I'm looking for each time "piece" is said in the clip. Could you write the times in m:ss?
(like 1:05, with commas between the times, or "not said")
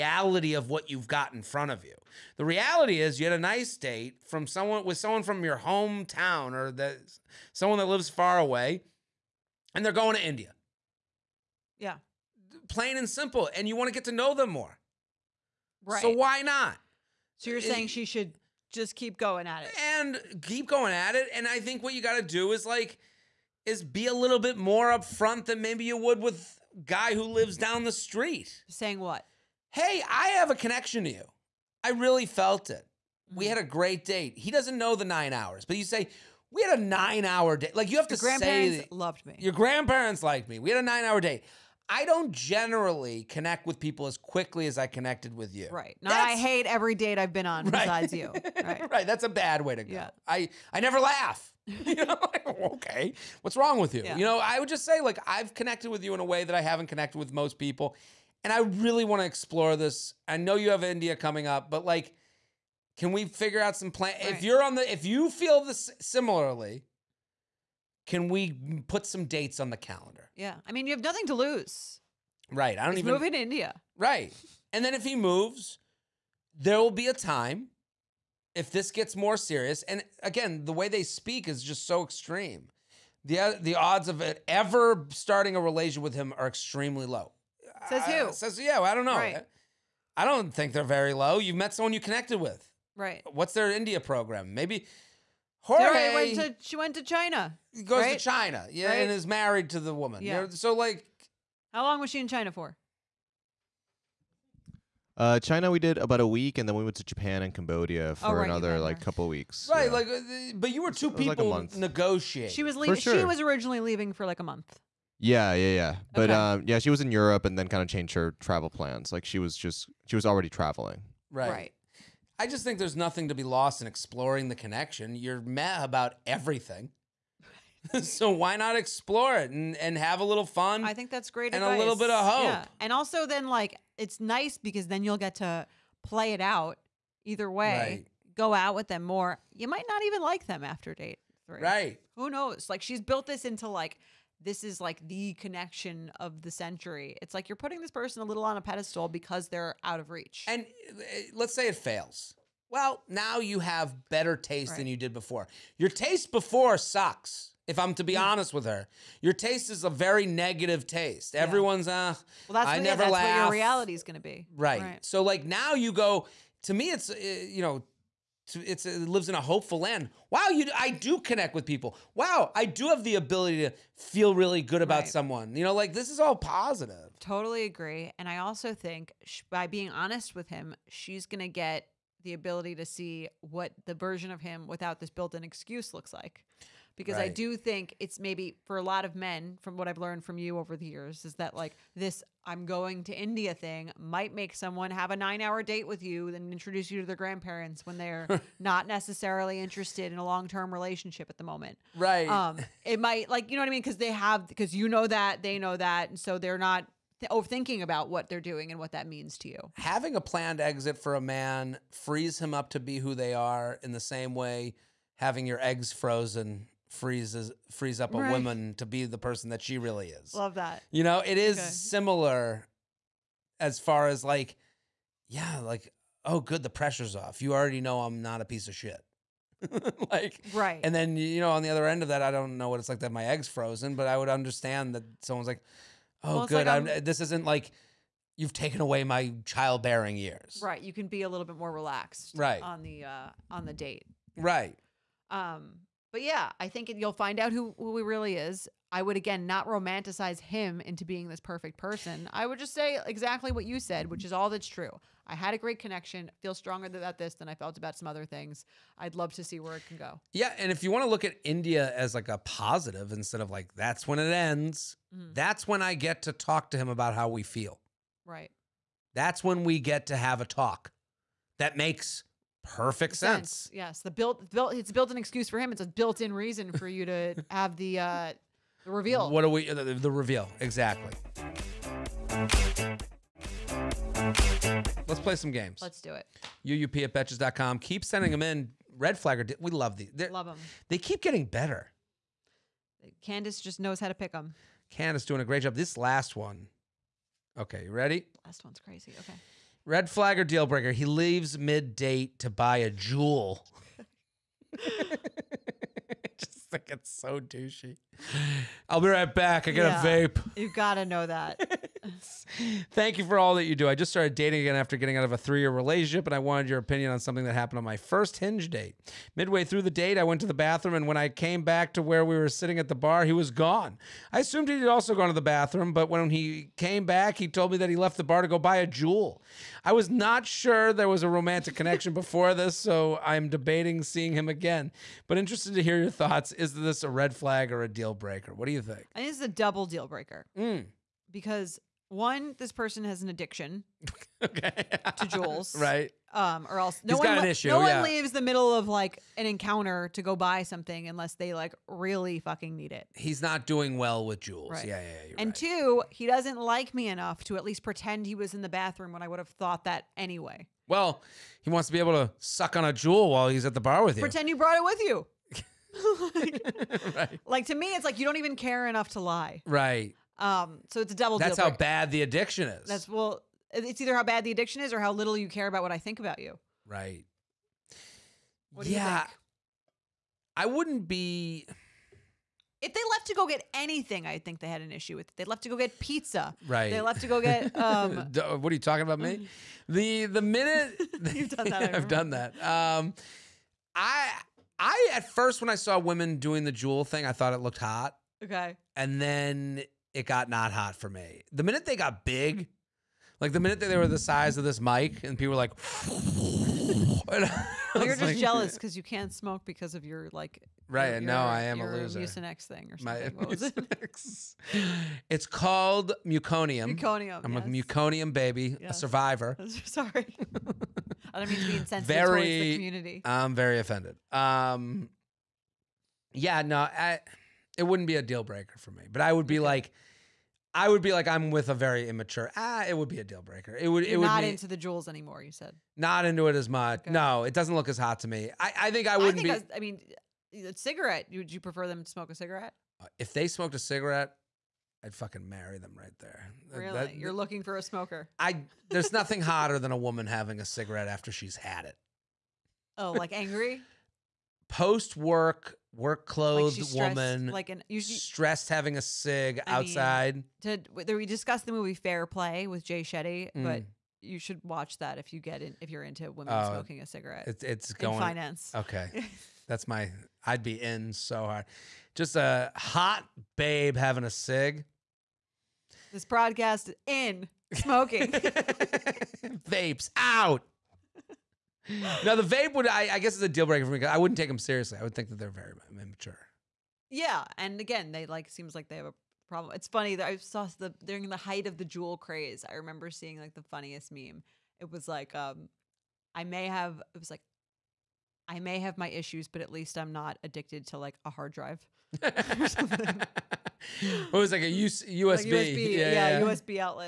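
3:48.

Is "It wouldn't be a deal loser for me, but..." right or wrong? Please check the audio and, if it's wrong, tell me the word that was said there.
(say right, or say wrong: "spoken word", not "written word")
wrong: "breaker", not "loser".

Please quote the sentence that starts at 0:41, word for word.
I don't generally connect with people as quickly as I connected with you.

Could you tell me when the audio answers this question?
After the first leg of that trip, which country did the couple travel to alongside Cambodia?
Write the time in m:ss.
1:47.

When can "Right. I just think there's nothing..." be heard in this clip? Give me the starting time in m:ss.
2:01.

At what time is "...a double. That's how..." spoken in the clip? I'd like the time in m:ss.
6:11.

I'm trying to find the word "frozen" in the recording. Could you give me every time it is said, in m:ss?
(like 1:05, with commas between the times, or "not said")
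3:35, 3:53.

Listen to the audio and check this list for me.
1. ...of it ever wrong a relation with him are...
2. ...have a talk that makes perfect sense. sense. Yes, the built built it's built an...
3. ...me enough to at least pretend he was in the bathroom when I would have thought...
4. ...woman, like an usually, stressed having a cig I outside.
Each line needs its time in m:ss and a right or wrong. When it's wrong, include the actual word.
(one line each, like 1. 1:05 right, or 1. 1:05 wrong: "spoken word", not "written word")
1. 1:24 wrong: "starting", not "wrong"
2. 4:30 right
3. 5:56 right
4. 7:37 right.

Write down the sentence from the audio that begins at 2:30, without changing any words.
And uh, let's say it fails.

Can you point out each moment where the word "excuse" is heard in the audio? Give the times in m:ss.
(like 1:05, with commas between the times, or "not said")
3:05, 4:35.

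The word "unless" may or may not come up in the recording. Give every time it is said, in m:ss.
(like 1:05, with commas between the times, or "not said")
5:51.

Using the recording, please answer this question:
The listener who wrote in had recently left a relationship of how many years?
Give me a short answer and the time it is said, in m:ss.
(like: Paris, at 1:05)
3, at 5:15.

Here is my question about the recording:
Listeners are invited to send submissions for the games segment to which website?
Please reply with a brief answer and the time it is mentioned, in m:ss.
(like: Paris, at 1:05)
betches.com, at 4:47.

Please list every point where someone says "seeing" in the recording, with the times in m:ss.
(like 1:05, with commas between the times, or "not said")
5:34, 8:13.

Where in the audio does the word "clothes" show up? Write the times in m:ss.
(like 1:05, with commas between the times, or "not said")
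7:36.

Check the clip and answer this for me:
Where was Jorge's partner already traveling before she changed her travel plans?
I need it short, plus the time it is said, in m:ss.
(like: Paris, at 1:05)
Europe, at 1:56.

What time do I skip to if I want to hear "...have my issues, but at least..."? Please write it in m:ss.
8:18.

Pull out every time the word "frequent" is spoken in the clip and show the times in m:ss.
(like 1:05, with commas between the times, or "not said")
not said.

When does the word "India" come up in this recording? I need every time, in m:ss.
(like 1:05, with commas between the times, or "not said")
0:10, 1:00, 1:13, 1:33, 3:13, 4:21.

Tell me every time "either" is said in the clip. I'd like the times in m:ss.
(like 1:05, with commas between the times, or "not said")
2:17, 6:14.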